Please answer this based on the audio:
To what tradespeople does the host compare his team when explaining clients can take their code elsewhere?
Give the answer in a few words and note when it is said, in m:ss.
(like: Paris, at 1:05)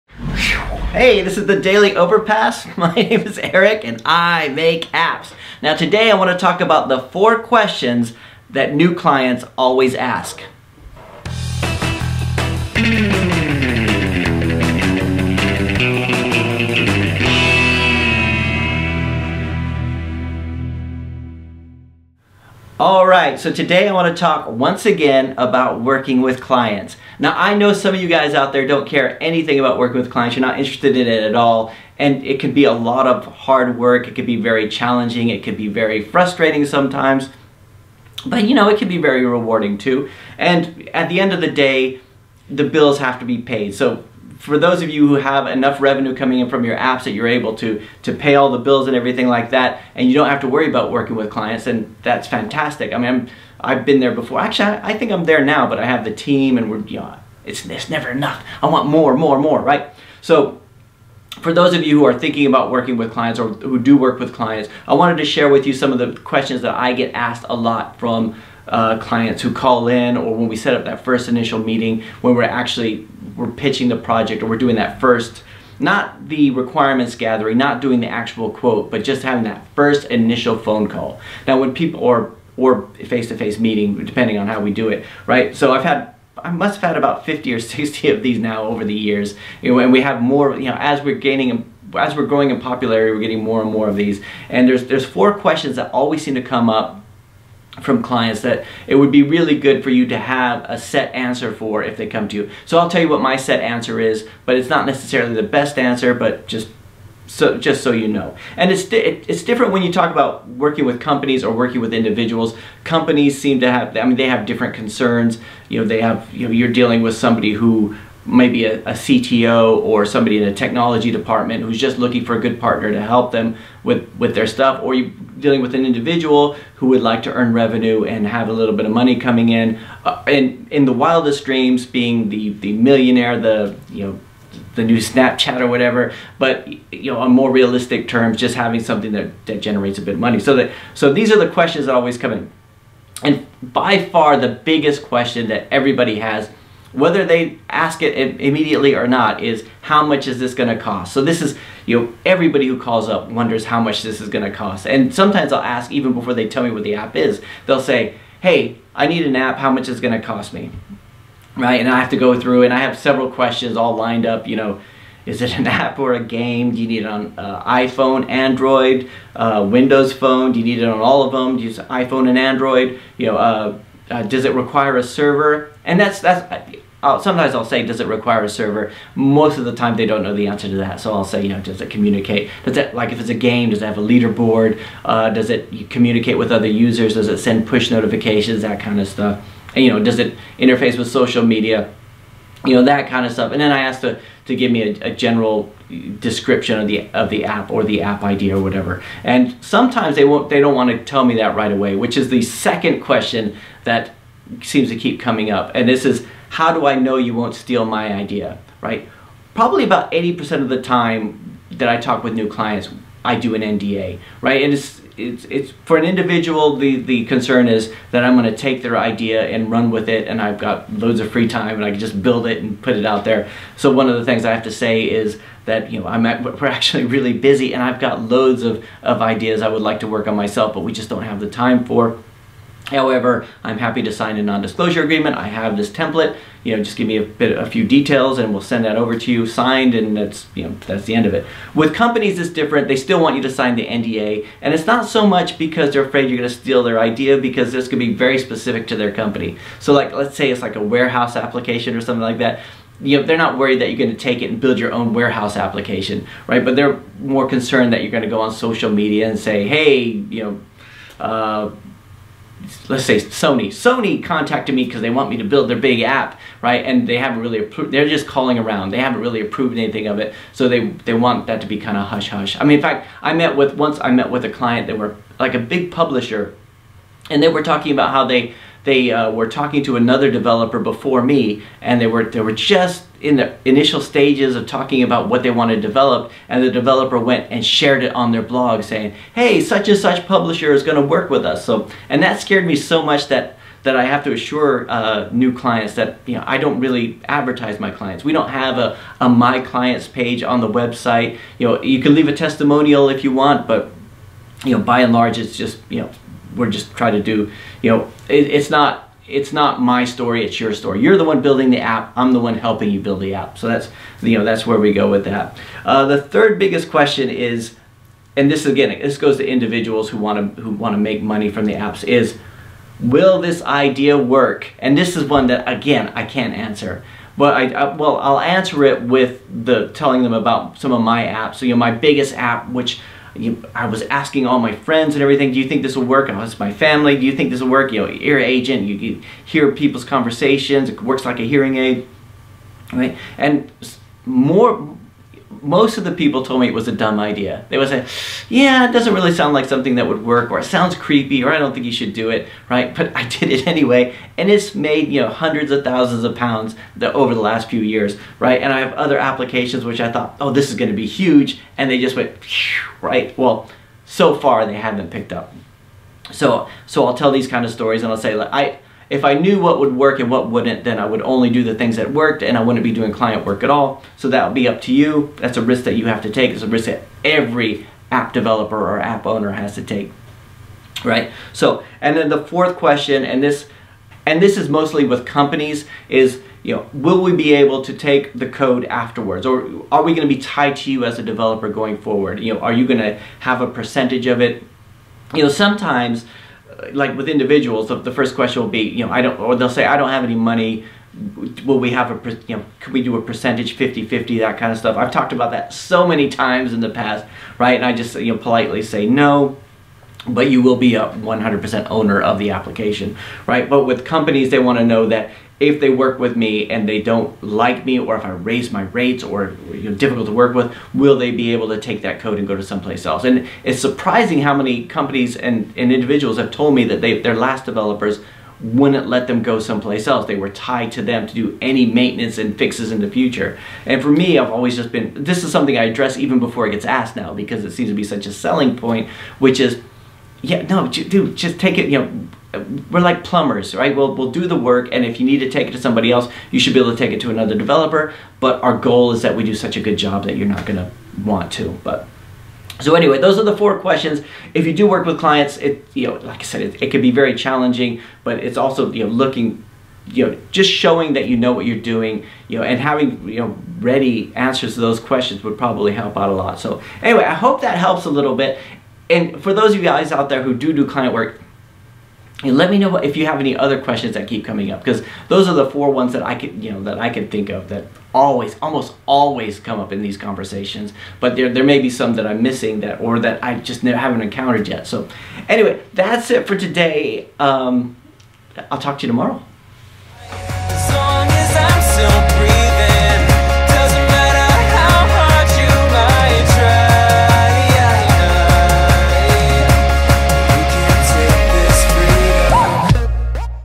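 plumbers, at 7:23.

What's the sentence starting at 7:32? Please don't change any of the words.
So anyway, those are the four questions.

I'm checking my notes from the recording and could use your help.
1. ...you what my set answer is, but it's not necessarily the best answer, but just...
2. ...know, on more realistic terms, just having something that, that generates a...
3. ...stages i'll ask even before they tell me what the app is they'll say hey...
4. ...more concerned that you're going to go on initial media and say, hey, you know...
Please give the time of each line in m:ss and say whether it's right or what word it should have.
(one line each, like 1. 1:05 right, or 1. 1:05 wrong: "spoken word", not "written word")
1. 1:43 right
2. 2:17 right
3. 2:35 wrong: "sometimes", not "stages"
4. 4:17 wrong: "social", not "initial".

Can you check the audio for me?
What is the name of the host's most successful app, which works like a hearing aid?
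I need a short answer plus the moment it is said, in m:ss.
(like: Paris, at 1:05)
Ear Agent, at 5:38.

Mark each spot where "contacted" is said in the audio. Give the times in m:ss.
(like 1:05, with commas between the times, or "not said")
4:24.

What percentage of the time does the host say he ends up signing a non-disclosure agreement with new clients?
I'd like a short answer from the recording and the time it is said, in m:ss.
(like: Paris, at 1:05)
80%, at 3:30.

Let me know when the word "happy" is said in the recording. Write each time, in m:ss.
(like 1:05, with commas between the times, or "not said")
3:53.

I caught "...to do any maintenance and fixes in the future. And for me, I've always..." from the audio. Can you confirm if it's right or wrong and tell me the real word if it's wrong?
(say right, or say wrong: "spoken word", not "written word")
right.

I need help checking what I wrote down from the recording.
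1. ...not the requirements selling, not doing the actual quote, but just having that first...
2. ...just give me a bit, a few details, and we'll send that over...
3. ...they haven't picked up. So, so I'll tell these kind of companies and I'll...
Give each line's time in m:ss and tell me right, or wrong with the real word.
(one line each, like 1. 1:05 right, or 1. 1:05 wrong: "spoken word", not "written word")
1. 1:15 wrong: "gathering", not "selling"
2. 3:56 right
3. 6:04 wrong: "stories", not "companies".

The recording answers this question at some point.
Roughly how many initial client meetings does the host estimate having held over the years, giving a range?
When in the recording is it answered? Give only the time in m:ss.
1:27.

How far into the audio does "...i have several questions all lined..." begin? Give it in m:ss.
2:42.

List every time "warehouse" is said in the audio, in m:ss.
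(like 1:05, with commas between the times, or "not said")
4:10, 4:15.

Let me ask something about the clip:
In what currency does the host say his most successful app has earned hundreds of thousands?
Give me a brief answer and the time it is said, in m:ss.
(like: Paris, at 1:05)
pounds, at 5:56.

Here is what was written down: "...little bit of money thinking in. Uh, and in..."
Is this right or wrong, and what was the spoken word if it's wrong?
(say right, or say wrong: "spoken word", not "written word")
wrong: "coming", not "thinking".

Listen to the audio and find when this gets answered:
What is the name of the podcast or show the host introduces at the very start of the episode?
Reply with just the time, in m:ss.
0:01.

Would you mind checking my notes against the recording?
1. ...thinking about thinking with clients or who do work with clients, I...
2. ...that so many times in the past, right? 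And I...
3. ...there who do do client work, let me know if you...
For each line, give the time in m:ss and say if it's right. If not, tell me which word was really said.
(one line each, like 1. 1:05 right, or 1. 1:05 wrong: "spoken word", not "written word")
1. 1:02 wrong: "working", not "thinking"
2. 6:45 right
3. 7:50 right.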